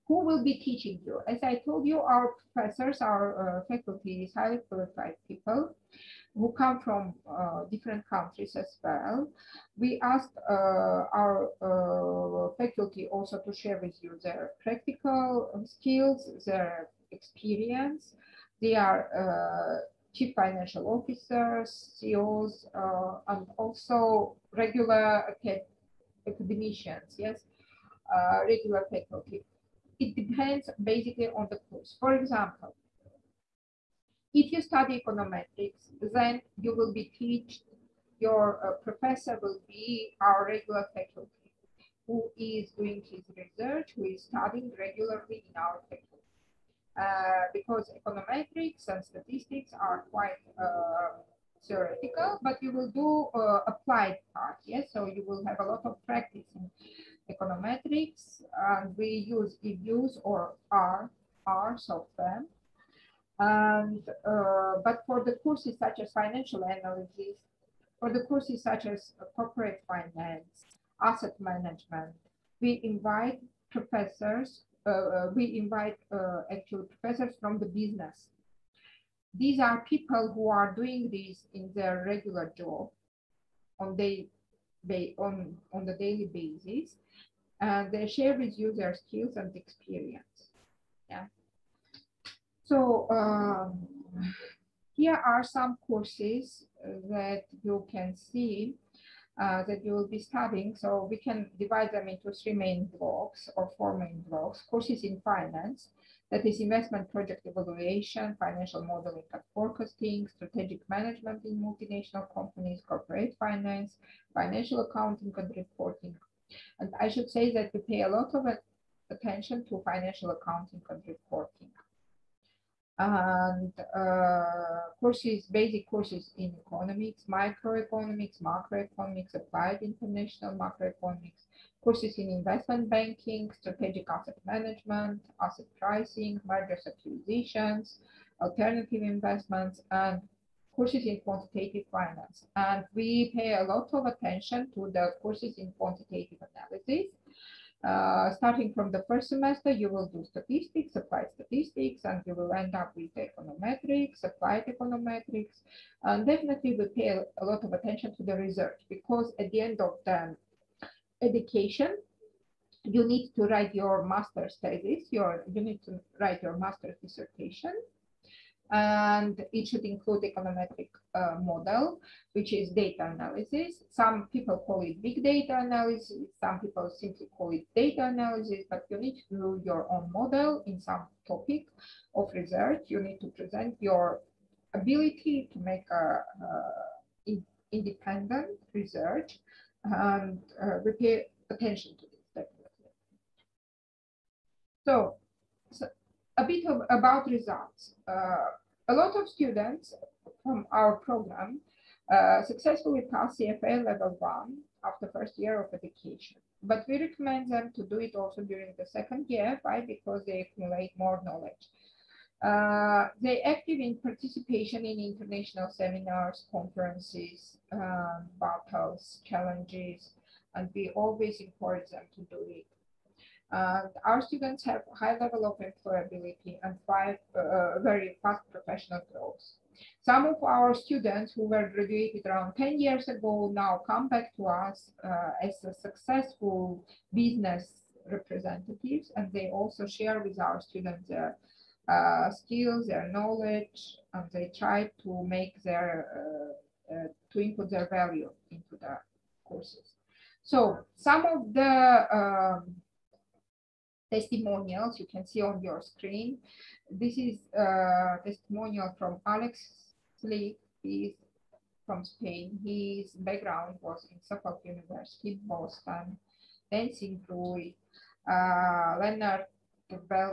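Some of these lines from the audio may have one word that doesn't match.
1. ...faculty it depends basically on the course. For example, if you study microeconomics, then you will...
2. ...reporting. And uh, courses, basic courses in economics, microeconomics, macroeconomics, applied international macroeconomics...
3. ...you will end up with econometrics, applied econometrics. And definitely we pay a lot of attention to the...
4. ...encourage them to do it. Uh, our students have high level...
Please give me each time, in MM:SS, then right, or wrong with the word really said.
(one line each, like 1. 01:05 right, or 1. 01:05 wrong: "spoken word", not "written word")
1. 00:28 wrong: "econometrics", not "microeconomics"
2. 02:01 right
3. 02:32 right
4. 03:41 right.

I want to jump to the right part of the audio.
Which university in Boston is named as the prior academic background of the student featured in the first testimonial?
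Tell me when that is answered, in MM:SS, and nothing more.
04:24.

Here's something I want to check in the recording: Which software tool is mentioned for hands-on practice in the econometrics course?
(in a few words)
EViews.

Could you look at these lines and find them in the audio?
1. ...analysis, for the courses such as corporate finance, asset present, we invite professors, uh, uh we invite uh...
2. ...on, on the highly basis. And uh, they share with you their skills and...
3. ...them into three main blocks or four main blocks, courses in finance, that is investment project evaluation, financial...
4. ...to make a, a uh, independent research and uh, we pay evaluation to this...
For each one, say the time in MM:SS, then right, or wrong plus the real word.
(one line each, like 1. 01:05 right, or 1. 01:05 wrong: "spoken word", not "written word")
1. 01:06 wrong: "management", not "present"
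2. 01:25 wrong: "daily", not "highly"
3. 01:41 right
4. 03:05 wrong: "attention", not "evaluation".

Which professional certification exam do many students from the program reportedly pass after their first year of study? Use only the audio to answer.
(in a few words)
CFA level one.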